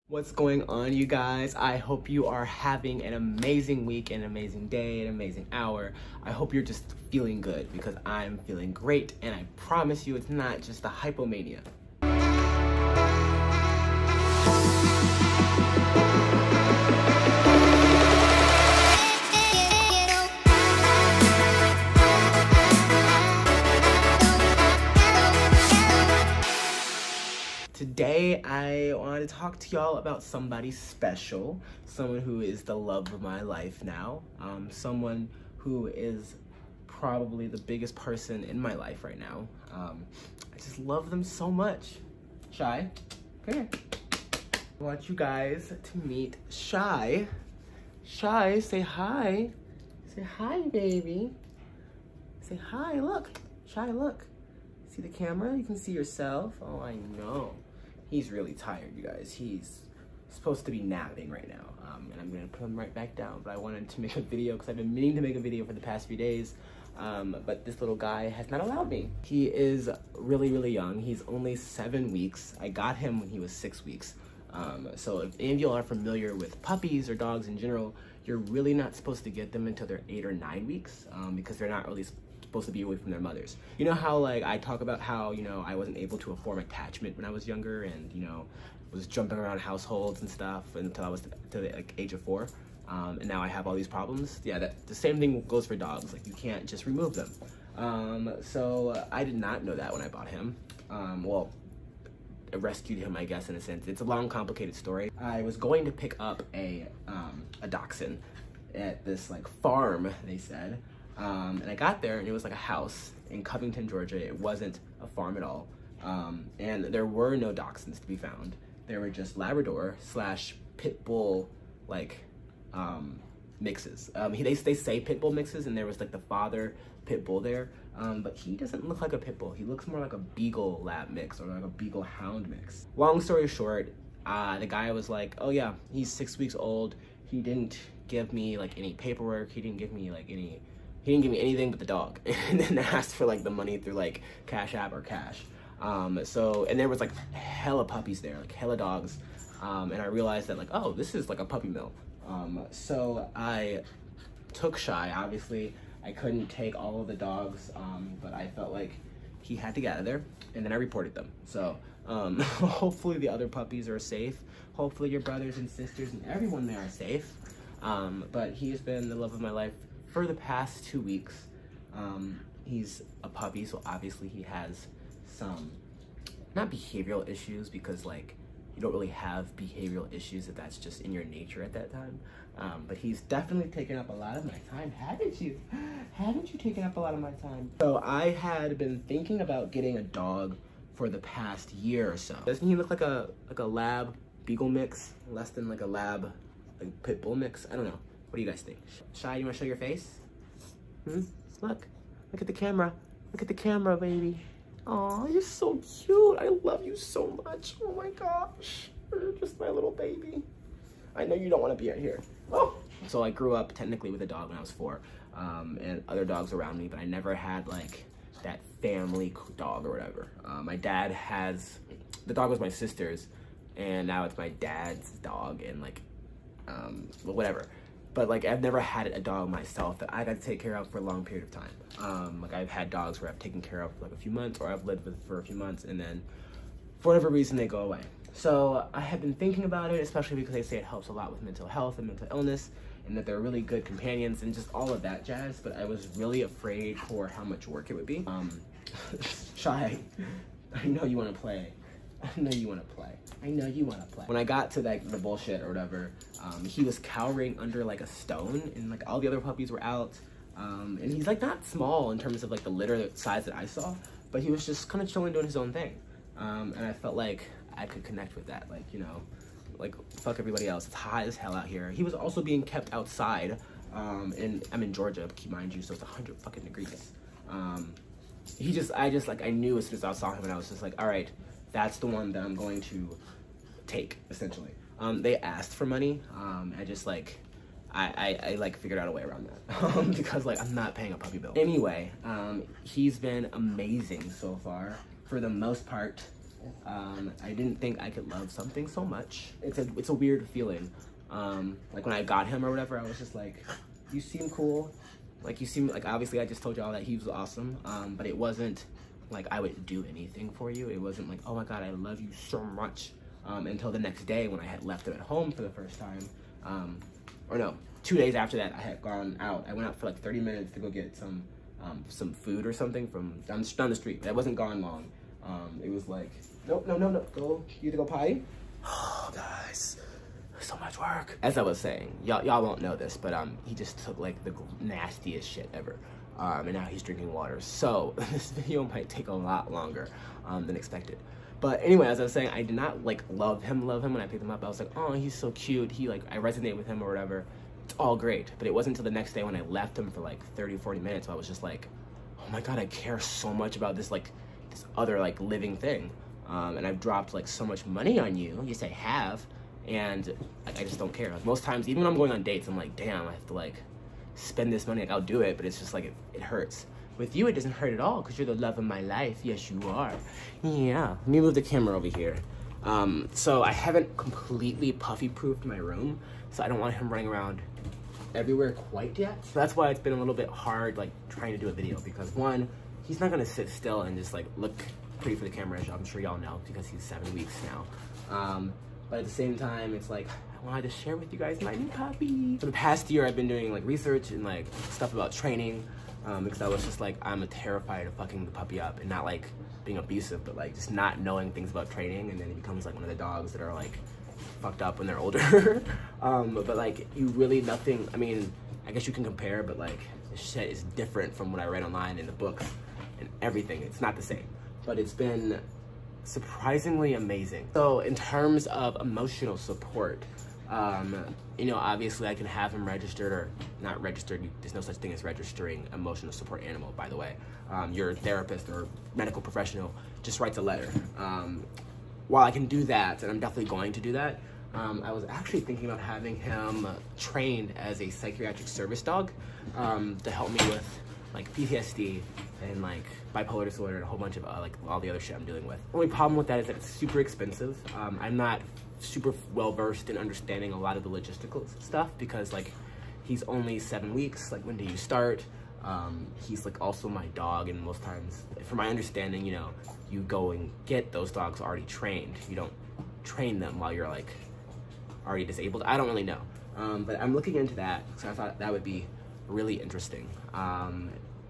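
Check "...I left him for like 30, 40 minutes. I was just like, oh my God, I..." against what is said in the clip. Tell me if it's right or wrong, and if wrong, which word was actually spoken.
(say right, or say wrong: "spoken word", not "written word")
right.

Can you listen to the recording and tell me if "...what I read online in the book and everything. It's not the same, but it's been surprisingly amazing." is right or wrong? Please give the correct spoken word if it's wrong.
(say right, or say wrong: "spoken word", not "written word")
right.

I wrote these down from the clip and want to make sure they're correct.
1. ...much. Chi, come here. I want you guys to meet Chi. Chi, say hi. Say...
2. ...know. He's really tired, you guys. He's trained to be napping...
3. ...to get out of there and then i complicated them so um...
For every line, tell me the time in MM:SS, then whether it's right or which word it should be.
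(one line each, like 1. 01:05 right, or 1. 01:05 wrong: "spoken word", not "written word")
1. 00:41 right
2. 00:57 wrong: "supposed", not "trained"
3. 02:39 wrong: "reported", not "complicated".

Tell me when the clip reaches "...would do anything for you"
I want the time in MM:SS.
05:09.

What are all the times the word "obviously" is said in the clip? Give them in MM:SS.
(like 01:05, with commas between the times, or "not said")
02:35, 02:53, 05:06, 07:01.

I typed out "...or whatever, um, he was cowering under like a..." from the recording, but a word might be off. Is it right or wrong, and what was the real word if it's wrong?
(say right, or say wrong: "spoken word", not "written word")
right.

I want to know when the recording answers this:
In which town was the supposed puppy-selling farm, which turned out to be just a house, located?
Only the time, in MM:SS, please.
01:53.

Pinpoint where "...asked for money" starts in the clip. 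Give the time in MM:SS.
04:45.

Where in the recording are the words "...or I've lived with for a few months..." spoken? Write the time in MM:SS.
03:54.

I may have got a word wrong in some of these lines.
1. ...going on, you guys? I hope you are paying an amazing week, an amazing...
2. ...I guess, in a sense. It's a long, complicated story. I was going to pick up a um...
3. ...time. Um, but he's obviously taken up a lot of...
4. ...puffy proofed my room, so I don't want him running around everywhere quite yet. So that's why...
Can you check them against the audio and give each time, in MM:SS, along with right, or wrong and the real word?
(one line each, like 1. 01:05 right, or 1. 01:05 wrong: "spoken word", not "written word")
1. 00:00 wrong: "having", not "paying"
2. 01:43 right
3. 03:01 wrong: "definitely", not "obviously"
4. 06:14 right.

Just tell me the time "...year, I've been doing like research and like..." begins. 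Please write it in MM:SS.
06:33.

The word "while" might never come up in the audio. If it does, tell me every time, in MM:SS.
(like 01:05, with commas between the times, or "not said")
07:12, 07:43.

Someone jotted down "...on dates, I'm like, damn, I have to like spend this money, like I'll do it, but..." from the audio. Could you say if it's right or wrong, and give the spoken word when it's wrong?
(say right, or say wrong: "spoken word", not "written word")
right.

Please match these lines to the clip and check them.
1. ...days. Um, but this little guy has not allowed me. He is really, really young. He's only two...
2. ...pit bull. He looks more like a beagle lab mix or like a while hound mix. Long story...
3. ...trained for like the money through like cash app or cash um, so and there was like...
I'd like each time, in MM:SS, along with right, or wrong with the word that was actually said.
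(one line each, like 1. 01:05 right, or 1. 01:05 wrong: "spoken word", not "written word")
1. 01:06 wrong: "seven", not "two"
2. 02:09 wrong: "beagle", not "while"
3. 02:22 wrong: "asked", not "trained".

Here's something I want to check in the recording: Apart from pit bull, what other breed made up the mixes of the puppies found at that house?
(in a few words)
Labrador.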